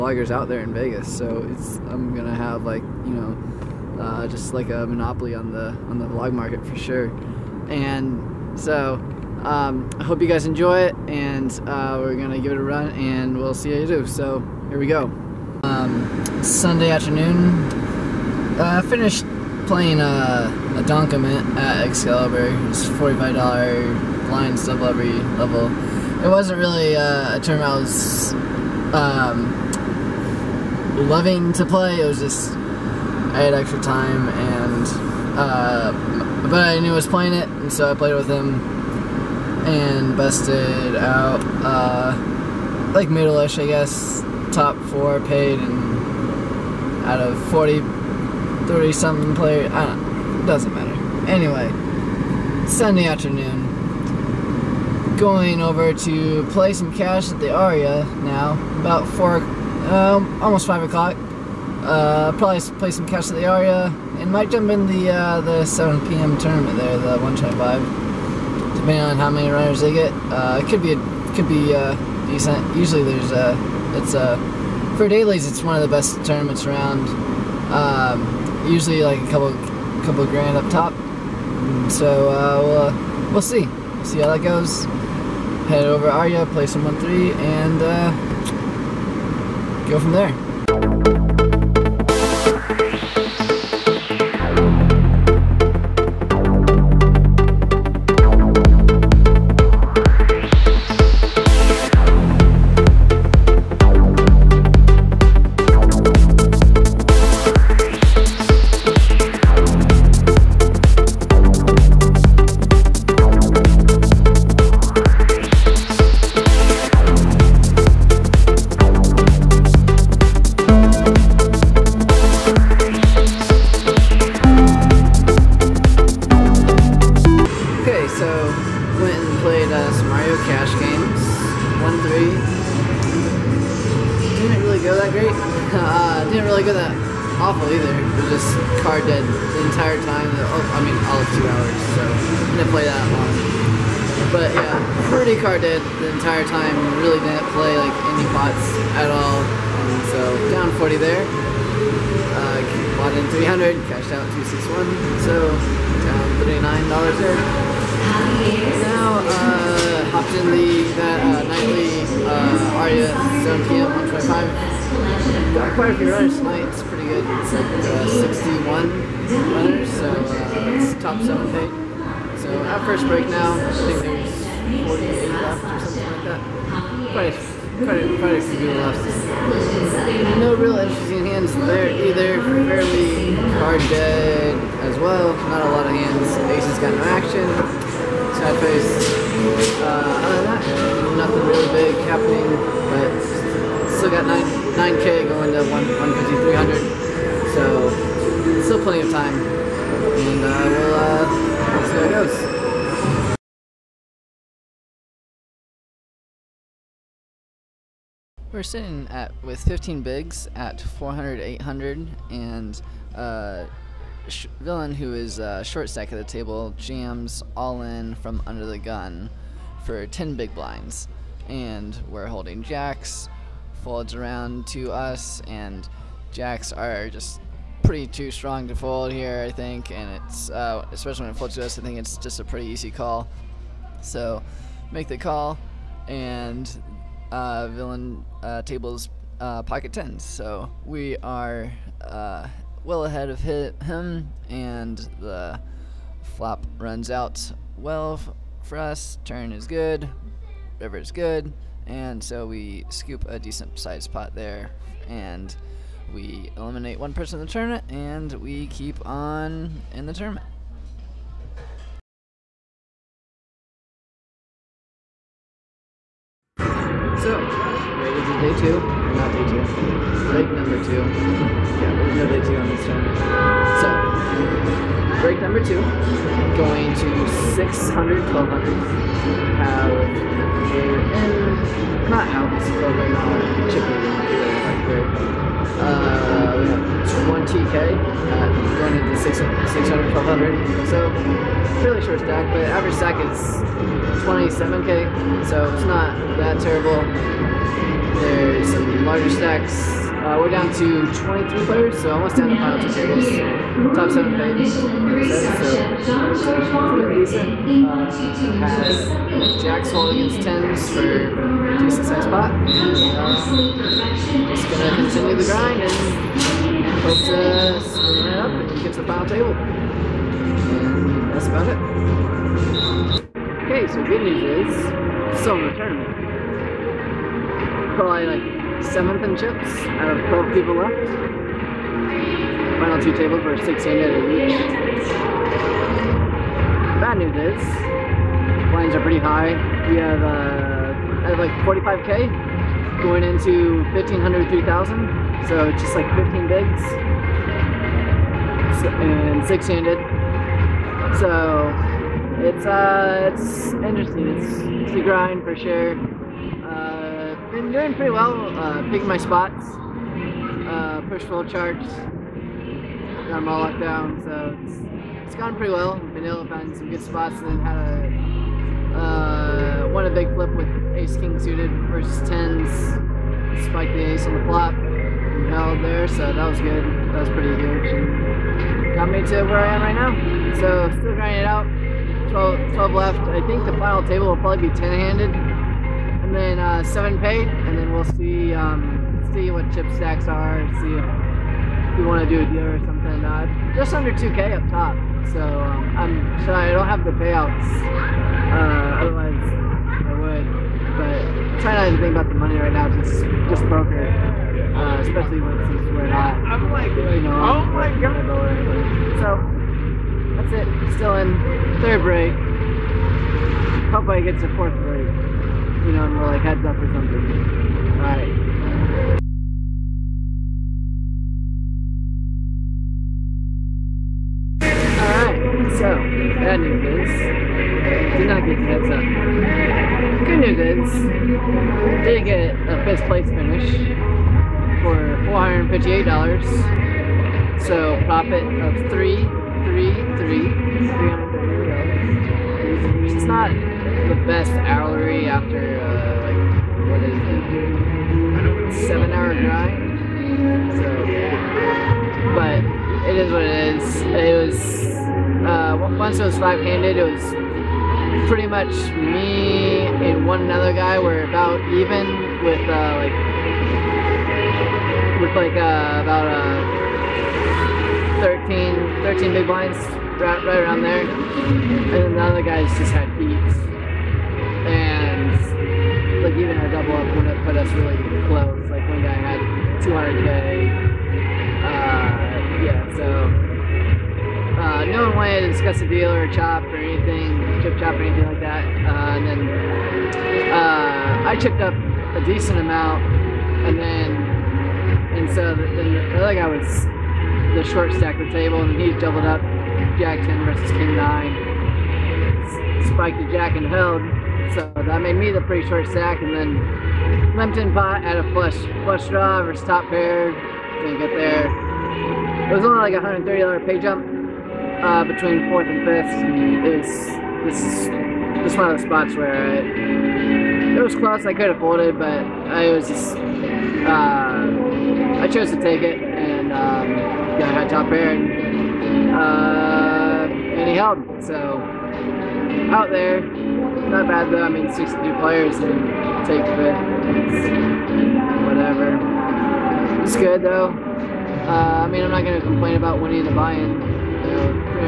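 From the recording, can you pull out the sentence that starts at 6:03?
Got them all locked down, so it's, it's gone pretty well.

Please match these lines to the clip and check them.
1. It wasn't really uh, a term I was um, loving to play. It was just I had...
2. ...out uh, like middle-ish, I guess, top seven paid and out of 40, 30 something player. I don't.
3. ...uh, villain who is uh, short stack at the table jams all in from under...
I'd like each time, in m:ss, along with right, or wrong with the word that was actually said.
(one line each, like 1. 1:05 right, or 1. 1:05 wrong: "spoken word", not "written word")
1. 0:26 right
2. 0:40 wrong: "four", not "seven"
3. 3:33 right.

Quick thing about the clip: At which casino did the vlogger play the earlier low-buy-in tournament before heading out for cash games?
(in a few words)
Excalibur.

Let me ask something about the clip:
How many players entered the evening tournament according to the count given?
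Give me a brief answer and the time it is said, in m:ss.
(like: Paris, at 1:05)
61, at 2:48.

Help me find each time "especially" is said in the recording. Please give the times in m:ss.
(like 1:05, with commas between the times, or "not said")
3:50, 6:44.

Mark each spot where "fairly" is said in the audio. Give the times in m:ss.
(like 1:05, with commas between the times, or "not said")
3:02, 4:51.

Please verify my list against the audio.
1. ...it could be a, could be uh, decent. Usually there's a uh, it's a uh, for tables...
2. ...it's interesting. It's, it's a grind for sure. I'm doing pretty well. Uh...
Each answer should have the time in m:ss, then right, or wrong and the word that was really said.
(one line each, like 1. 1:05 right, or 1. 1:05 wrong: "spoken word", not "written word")
1. 1:10 wrong: "dailies", not "tables"
2. 5:53 right.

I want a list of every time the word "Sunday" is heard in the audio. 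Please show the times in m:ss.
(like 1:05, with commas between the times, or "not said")
0:16, 0:52.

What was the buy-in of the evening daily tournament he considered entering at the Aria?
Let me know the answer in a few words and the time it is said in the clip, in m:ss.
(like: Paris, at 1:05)
125, at 1:06.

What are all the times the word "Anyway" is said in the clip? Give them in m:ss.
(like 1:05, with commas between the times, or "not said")
0:51.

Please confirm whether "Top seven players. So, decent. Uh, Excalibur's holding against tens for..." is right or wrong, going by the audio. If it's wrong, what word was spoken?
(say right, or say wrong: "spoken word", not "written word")
wrong: "Jack", not "Excalibur".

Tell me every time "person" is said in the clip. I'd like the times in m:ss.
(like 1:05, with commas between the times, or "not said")
4:17.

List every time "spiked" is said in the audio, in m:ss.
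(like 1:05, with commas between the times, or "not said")
6:13, 8:22.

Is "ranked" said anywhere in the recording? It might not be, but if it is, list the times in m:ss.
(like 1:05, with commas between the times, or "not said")
not said.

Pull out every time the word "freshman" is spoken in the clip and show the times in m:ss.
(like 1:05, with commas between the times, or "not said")
not said.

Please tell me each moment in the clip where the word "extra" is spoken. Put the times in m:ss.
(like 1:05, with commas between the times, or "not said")
0:33.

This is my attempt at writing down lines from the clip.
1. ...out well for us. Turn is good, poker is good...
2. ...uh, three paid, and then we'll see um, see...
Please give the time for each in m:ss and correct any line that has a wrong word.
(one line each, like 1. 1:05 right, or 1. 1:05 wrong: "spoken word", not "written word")
1. 4:07 wrong: "river", not "poker"
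2. 6:26 wrong: "seven", not "three".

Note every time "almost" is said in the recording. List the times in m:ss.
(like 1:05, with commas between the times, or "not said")
1:00, 5:02.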